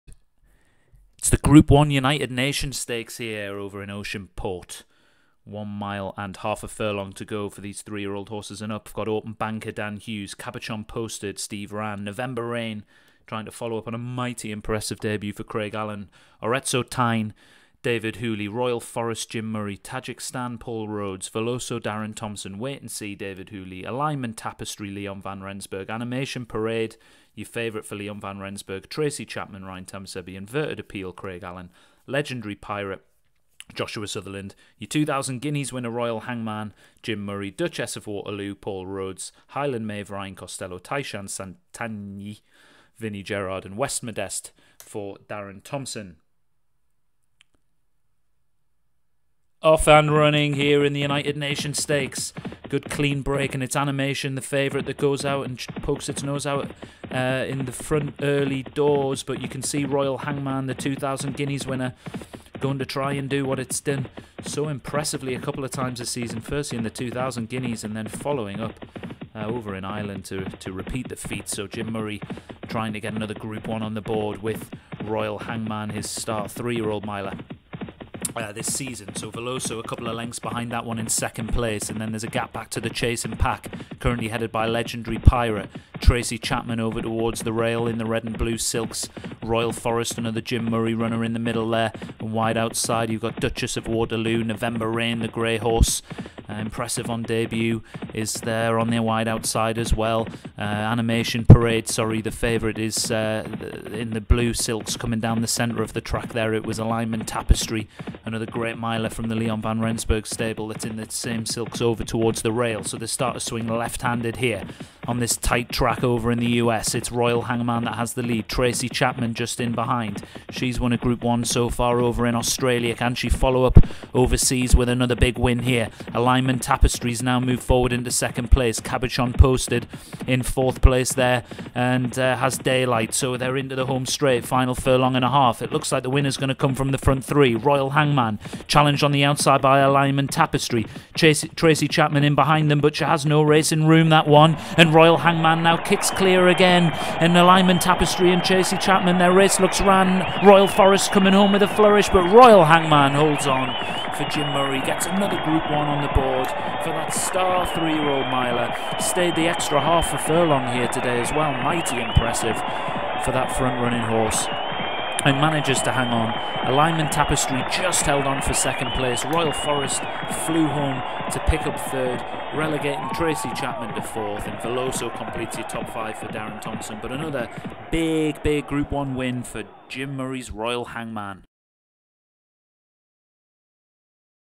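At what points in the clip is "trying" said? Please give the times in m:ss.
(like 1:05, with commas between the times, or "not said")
0:13, 1:12.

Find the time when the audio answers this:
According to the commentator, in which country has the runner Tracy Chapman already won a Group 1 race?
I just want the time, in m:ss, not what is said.
2:02.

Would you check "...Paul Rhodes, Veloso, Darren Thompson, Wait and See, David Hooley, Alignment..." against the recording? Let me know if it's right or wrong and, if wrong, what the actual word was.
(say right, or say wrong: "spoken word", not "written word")
right.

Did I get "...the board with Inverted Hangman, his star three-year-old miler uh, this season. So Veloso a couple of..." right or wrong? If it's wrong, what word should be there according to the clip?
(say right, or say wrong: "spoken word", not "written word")
wrong: "Royal", not "Inverted".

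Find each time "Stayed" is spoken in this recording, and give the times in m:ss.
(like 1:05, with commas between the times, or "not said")
2:38.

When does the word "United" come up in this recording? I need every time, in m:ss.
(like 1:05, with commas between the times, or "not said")
0:01, 0:51.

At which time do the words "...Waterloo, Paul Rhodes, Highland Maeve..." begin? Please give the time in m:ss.
0:38.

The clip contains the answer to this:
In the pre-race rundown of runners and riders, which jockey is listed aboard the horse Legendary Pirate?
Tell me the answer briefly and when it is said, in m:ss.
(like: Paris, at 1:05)
Joshua Sutherland, at 0:33.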